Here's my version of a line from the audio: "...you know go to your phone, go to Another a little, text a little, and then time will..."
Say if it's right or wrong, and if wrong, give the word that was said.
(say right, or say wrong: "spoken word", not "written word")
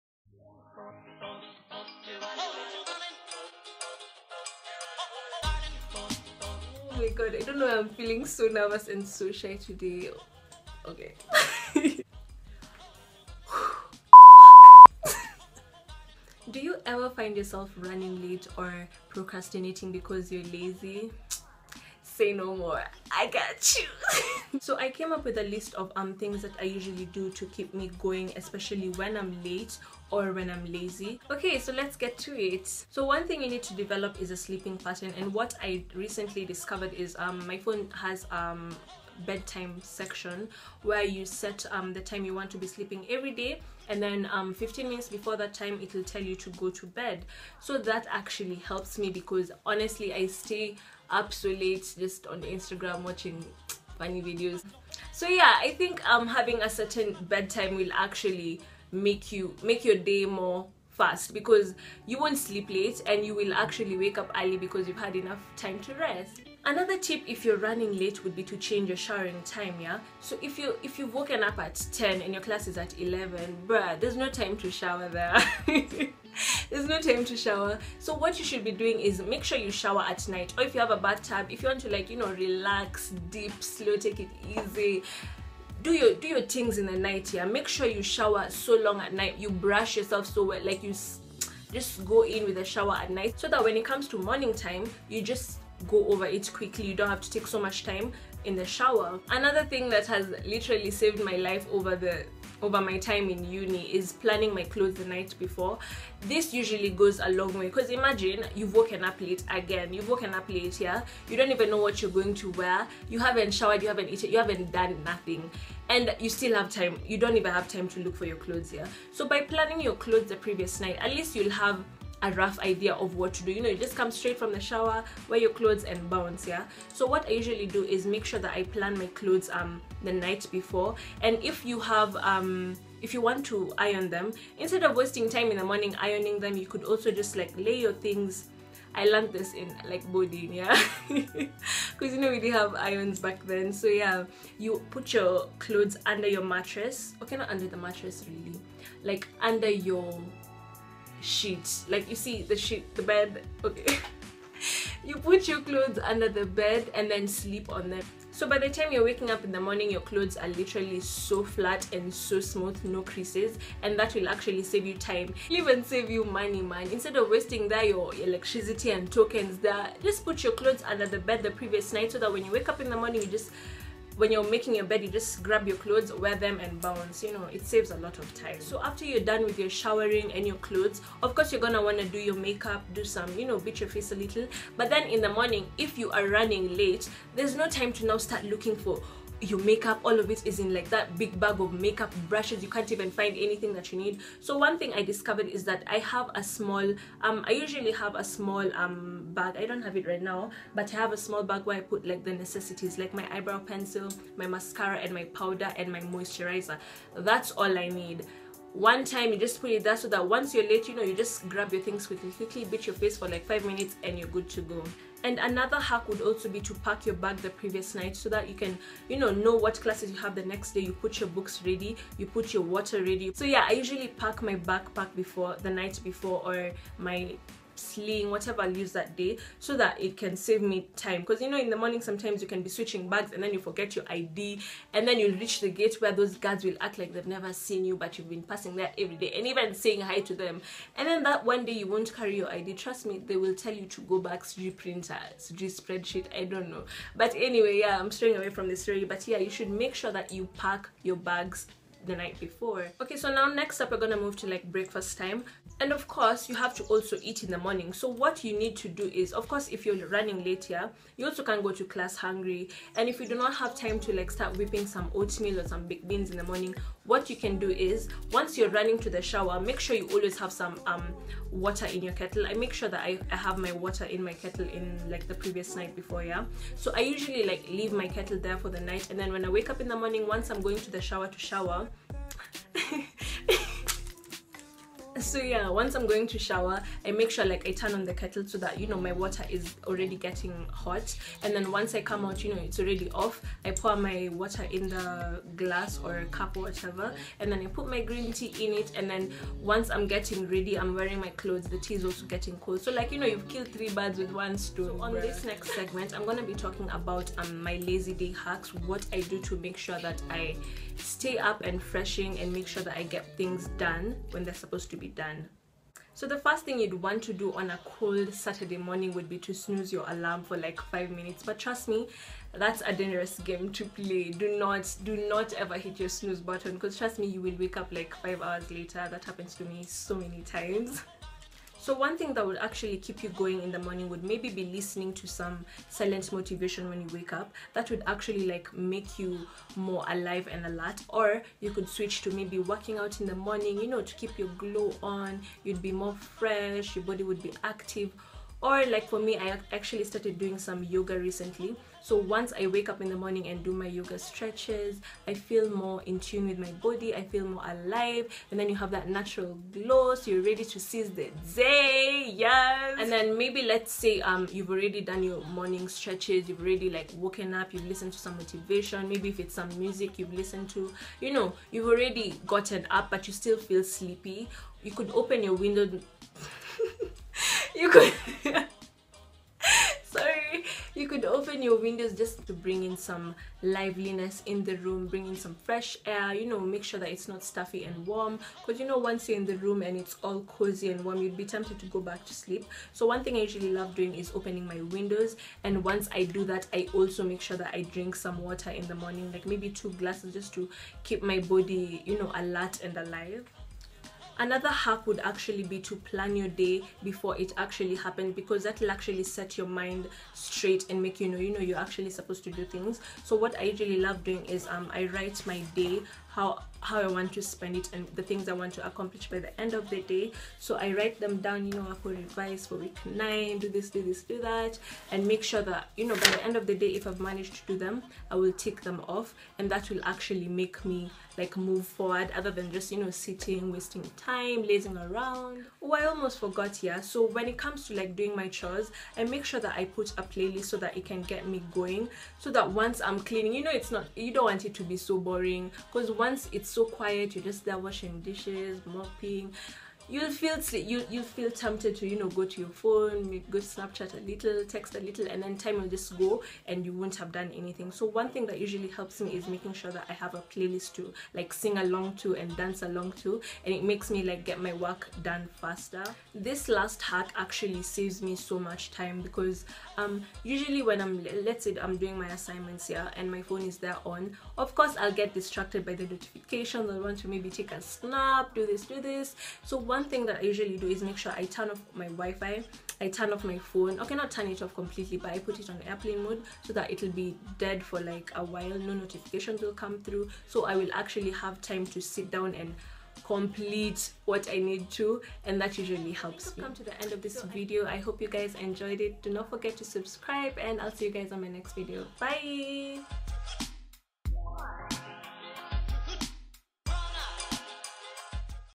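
wrong: "Snapchat", not "Another".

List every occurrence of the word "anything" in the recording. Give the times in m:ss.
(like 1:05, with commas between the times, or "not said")
3:13, 7:37.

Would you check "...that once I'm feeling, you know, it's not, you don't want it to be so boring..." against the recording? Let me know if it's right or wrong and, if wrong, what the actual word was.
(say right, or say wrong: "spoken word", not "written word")
wrong: "cleaning", not "feeling".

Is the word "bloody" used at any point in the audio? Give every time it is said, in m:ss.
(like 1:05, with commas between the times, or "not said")
not said.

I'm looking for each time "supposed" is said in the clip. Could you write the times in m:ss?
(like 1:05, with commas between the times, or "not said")
5:14, 6:52.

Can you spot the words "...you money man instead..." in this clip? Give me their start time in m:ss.
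2:46.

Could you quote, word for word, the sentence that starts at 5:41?
Or you could switch to maybe working out in the morning, you know, to keep your glow on.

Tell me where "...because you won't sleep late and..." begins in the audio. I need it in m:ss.
1:01.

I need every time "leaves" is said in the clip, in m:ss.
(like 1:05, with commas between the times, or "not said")
3:48, 4:37.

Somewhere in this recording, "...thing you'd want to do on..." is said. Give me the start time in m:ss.
5:16.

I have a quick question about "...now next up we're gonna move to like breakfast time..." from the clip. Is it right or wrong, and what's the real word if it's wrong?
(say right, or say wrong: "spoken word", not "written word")
right.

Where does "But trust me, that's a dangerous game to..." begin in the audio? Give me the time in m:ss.
5:21.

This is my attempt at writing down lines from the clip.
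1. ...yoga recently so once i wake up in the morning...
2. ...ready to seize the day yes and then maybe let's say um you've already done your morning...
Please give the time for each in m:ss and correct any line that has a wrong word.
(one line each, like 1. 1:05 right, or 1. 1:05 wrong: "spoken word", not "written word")
1. 5:50 right
2. 6:00 right.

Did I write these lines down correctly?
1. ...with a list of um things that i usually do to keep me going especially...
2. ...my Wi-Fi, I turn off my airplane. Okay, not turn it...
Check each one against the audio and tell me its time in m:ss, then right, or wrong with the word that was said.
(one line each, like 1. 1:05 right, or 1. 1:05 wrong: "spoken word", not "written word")
1. 0:25 right
2. 8:01 wrong: "phone", not "airplane".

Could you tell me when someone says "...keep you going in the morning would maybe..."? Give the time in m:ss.
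5:32.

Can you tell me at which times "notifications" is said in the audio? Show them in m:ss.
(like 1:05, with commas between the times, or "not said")
7:56, 8:08.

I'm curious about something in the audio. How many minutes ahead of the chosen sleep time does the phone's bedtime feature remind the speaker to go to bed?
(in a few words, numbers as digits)
15.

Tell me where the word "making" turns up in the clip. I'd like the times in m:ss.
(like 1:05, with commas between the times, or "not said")
2:54, 7:39.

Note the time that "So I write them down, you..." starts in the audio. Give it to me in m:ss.
7:00.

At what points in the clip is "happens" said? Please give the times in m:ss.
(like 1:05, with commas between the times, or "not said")
5:29, 6:47.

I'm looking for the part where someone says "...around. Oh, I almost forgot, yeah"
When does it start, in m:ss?
7:14.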